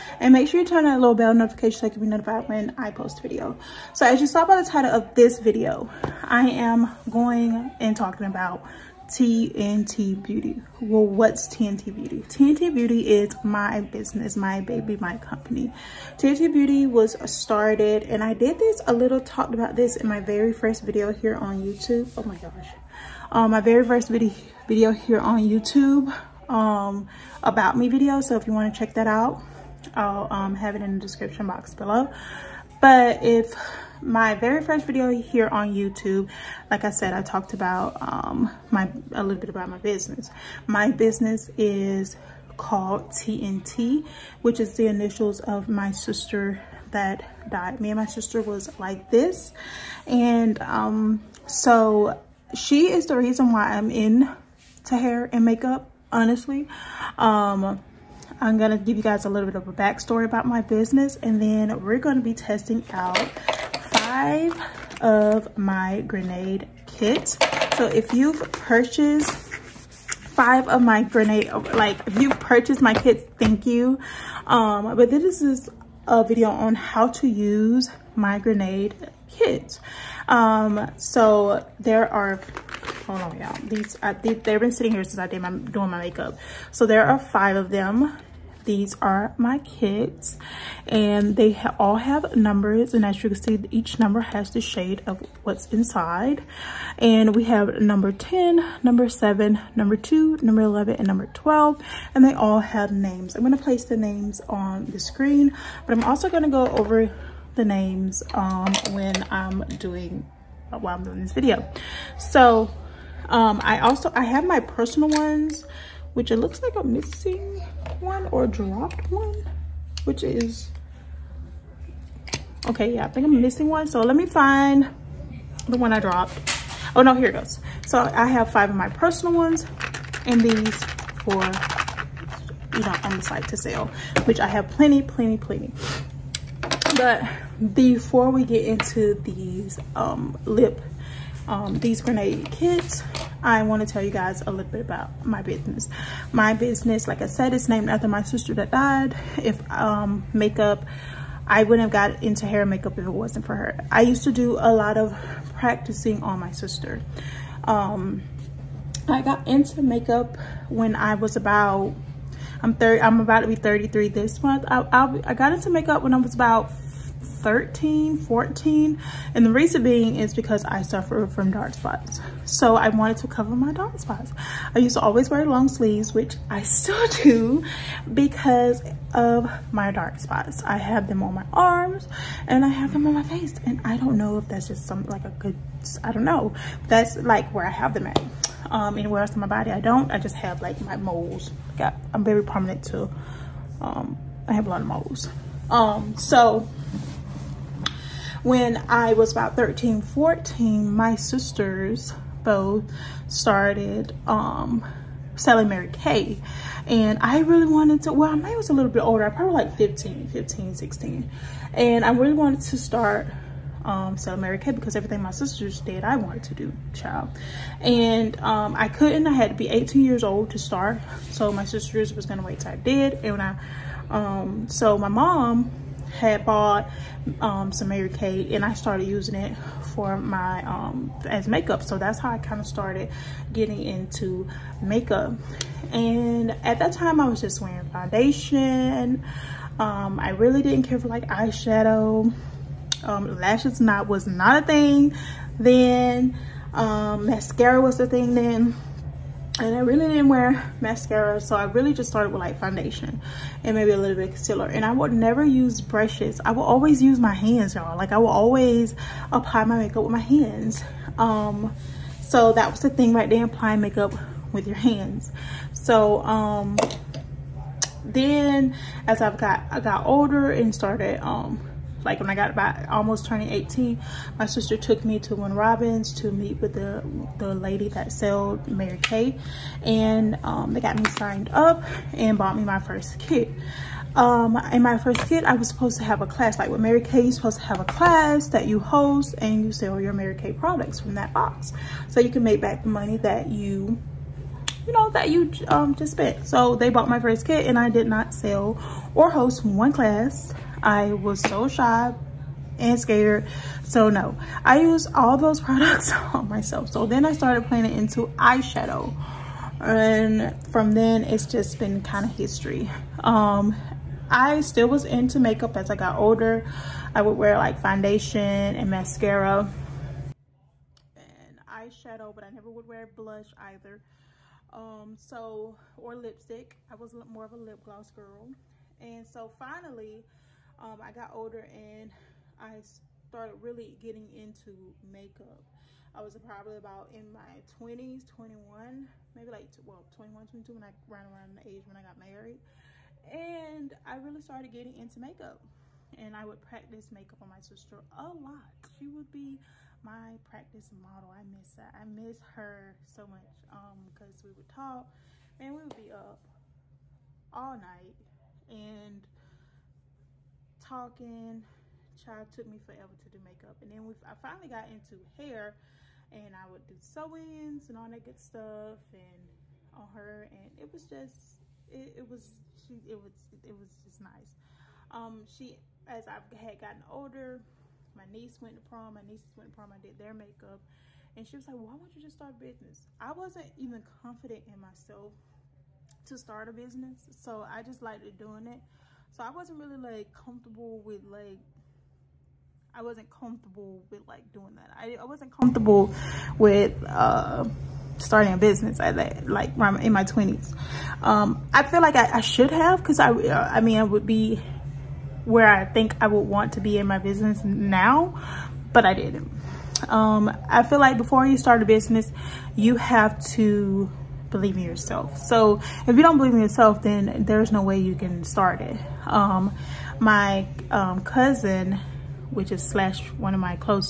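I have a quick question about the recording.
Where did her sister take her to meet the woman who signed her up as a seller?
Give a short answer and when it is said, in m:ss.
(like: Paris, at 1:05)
Win Robbins, at 4:35.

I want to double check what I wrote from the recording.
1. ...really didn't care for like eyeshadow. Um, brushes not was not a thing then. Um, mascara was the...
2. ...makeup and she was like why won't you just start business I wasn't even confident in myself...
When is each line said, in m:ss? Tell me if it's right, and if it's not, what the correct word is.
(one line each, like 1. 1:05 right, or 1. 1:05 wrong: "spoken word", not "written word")
1. 4:00 wrong: "lashes", not "brushes"
2. 6:20 right.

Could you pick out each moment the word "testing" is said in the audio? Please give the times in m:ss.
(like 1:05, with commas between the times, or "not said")
1:02.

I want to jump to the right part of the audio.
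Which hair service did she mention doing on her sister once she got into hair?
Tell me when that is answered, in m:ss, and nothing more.
6:06.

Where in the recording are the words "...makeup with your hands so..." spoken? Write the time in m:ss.
4:23.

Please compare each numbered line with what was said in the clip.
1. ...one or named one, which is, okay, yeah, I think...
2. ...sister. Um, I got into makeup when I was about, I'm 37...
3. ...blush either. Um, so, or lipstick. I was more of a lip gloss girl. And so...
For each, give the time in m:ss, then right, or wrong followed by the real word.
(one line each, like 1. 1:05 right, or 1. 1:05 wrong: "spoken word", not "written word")
1. 1:58 wrong: "dropped", not "named"
2. 2:36 wrong: "30", not "37"
3. 5:23 right.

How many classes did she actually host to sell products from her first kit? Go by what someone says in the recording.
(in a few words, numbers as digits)
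0.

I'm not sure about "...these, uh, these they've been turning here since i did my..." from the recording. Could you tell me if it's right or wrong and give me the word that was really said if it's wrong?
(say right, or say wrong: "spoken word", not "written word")
wrong: "sitting", not "turning".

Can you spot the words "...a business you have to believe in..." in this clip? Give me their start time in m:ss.
6:51.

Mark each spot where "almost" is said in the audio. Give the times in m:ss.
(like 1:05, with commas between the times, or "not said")
4:32.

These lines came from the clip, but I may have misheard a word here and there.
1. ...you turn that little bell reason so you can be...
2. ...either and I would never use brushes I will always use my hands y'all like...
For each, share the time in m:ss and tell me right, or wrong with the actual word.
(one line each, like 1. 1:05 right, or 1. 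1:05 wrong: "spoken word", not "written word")
1. 0:00 wrong: "notification", not "reason"
2. 4:14 wrong: "concealer", not "either".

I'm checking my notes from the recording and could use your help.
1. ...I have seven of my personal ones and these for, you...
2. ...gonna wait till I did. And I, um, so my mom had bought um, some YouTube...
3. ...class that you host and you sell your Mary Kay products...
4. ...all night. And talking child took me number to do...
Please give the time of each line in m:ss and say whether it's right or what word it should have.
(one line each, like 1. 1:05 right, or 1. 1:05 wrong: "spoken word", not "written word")
1. 2:08 wrong: "five", not "seven"
2. 3:42 wrong: "Mary", not "YouTube"
3. 4:47 right
4. 5:57 wrong: "forever", not "number".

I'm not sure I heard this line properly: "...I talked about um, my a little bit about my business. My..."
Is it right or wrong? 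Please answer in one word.
right.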